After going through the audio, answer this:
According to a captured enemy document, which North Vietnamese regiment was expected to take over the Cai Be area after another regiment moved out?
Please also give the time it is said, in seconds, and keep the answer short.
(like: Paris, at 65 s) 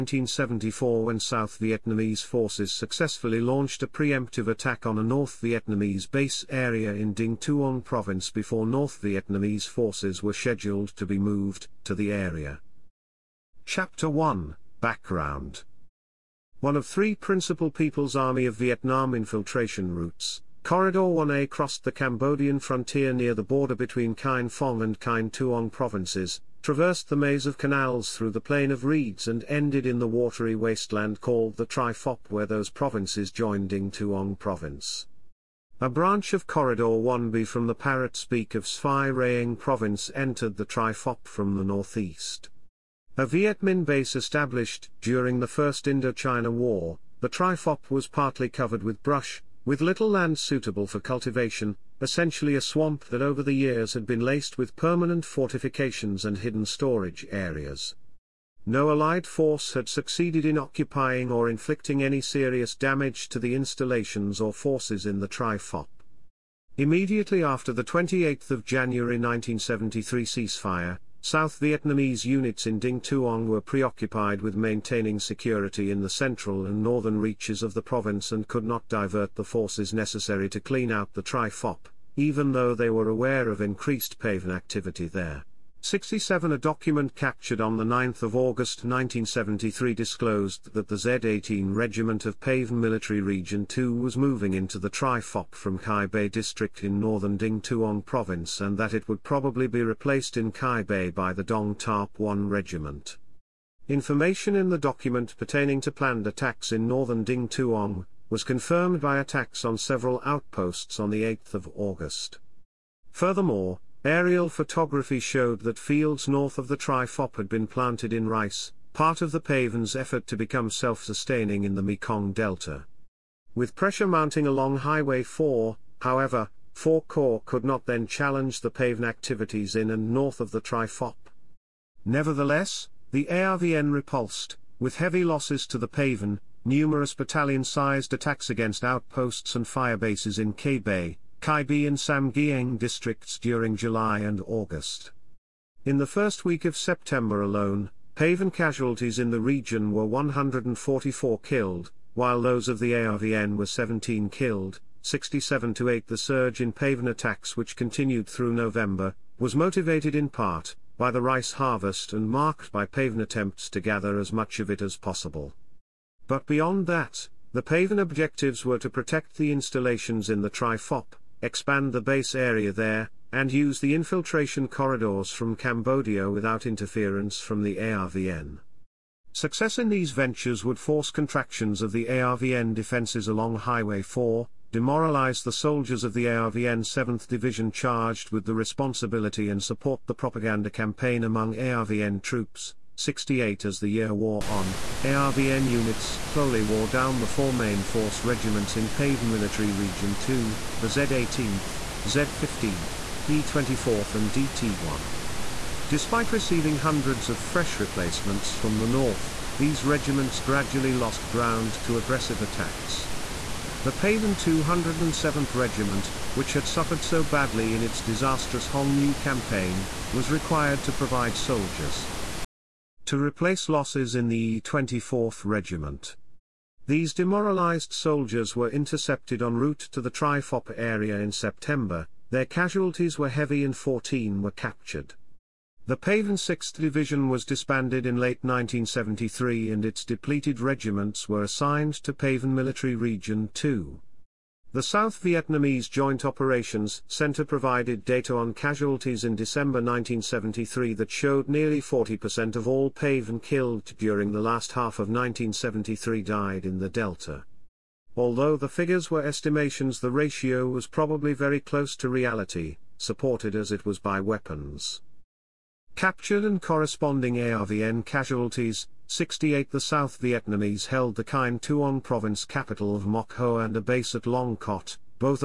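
Dong Thap 1 Regiment, at 101 s.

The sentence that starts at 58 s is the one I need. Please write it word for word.
No Allied force had succeeded in occupying or inflicting any serious damage to the installations or forces in the Tri Phap.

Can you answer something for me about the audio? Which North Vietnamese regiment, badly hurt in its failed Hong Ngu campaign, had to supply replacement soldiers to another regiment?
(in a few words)
207th Regiment.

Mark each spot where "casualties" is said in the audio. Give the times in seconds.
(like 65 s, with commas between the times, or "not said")
148 s, 232 s, 248 s, 268 s.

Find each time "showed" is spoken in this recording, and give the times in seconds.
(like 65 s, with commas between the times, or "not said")
115 s, 251 s.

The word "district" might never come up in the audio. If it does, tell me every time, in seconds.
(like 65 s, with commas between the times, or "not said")
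96 s, 142 s.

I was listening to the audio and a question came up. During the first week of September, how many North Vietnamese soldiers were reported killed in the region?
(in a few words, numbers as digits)
144.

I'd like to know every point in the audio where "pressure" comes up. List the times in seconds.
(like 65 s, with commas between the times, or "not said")
123 s.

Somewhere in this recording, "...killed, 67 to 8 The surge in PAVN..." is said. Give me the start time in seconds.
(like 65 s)
154 s.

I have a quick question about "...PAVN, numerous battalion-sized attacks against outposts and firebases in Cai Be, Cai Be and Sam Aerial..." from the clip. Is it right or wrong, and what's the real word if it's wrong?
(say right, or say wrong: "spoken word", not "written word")
wrong: "Giang", not "Aerial".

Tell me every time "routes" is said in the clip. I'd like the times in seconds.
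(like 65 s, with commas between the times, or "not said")
19 s, 229 s.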